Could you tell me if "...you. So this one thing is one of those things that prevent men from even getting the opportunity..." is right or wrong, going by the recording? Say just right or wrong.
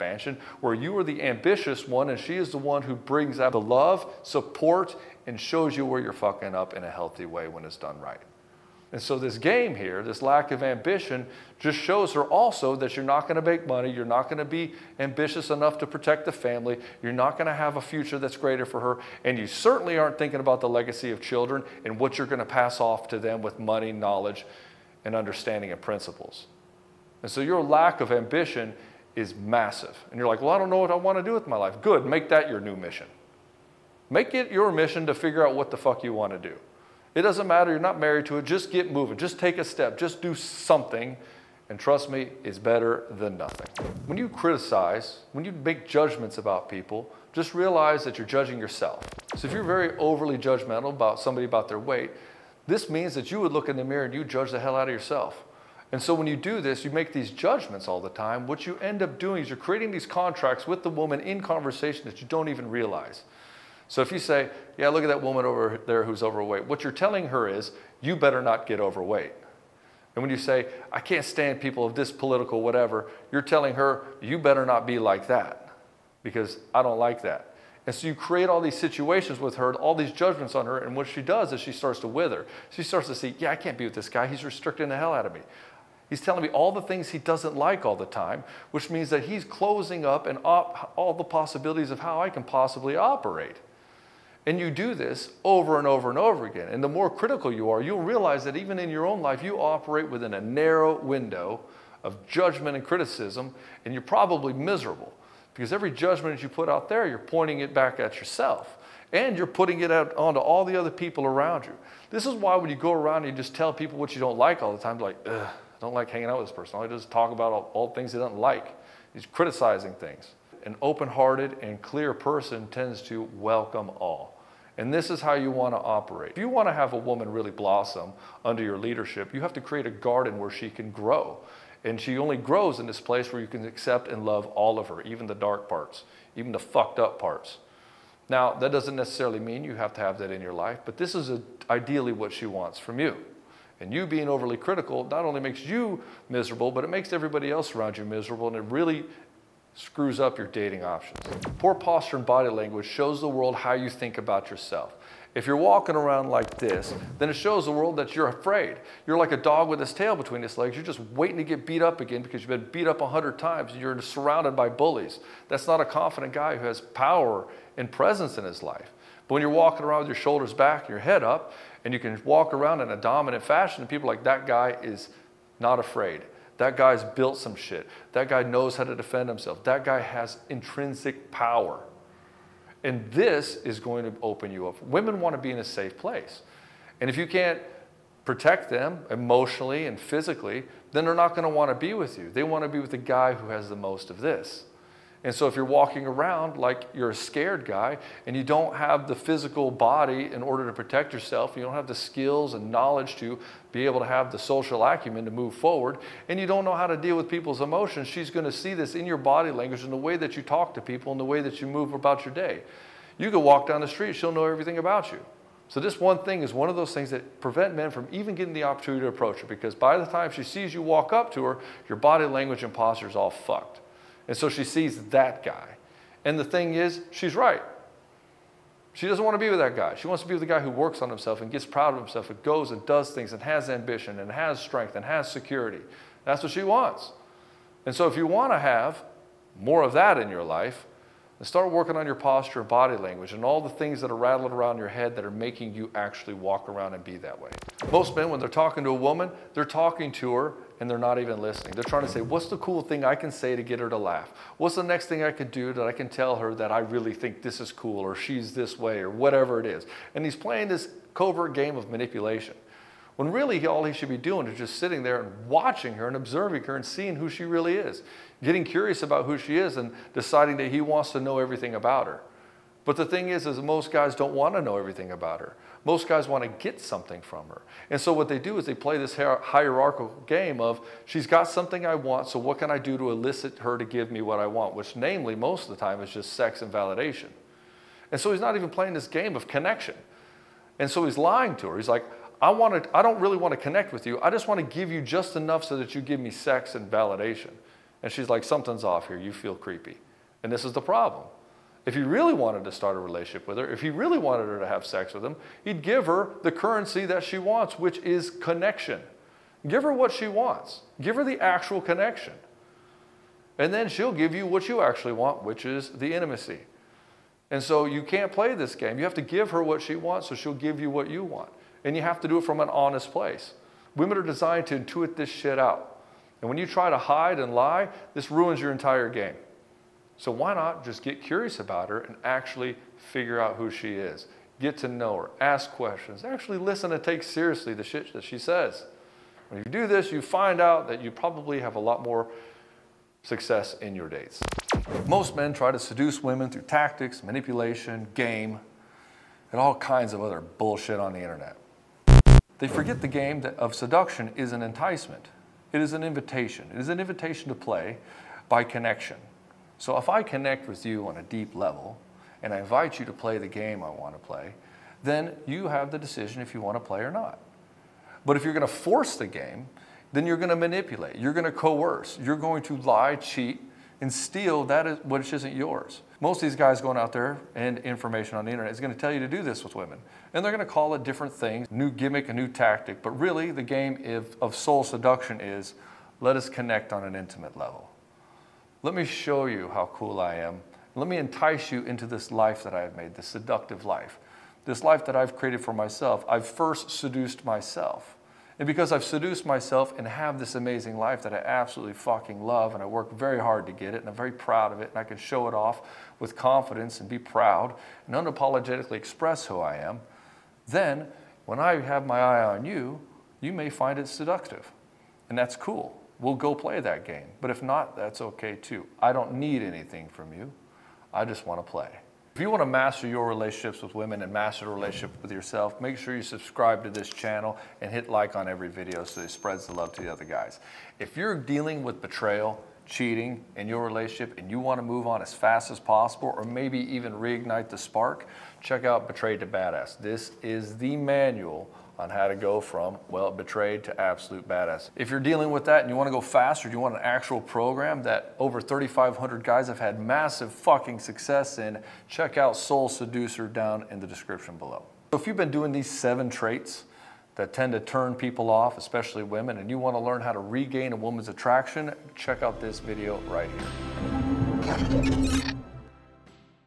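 right.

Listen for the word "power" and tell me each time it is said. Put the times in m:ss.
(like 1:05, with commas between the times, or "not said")
2:46, 3:01.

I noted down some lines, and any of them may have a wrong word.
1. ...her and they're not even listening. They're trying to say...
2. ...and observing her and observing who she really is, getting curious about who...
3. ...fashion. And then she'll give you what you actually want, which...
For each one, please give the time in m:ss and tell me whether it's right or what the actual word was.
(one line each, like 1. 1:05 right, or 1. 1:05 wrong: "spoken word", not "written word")
1. 4:10 right
2. 4:26 wrong: "seeing", not "observing"
3. 5:11 wrong: "connection", not "fashion".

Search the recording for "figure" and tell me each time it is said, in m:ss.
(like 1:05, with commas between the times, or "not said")
0:35, 5:32.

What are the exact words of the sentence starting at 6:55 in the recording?
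And that's cool we'll go play that game.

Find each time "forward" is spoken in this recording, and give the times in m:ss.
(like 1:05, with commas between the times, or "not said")
3:25.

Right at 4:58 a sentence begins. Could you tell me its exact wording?
And she's like, something's off here.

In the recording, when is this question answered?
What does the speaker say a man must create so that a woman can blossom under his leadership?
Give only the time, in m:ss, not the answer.
2:09.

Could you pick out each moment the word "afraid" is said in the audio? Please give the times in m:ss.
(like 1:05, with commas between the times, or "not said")
2:38, 2:55.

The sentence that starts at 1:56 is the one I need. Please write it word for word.
All I just talk about all, all things he doesn't like.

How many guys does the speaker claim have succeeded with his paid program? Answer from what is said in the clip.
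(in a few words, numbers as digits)
3,500.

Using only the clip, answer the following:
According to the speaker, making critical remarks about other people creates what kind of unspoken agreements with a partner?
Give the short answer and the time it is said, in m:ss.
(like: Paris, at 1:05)
contracts, at 1:00.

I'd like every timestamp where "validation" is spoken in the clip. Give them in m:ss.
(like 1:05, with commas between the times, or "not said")
4:46, 4:56.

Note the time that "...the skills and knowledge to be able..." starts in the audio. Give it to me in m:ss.
3:21.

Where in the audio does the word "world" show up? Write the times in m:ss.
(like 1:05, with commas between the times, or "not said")
2:33, 2:37.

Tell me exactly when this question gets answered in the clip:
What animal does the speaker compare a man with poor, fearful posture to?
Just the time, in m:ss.
2:39.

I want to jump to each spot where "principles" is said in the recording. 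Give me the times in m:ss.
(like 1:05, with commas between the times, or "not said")
0:25.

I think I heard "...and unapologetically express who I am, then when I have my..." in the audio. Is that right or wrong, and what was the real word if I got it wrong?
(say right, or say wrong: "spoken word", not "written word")
right.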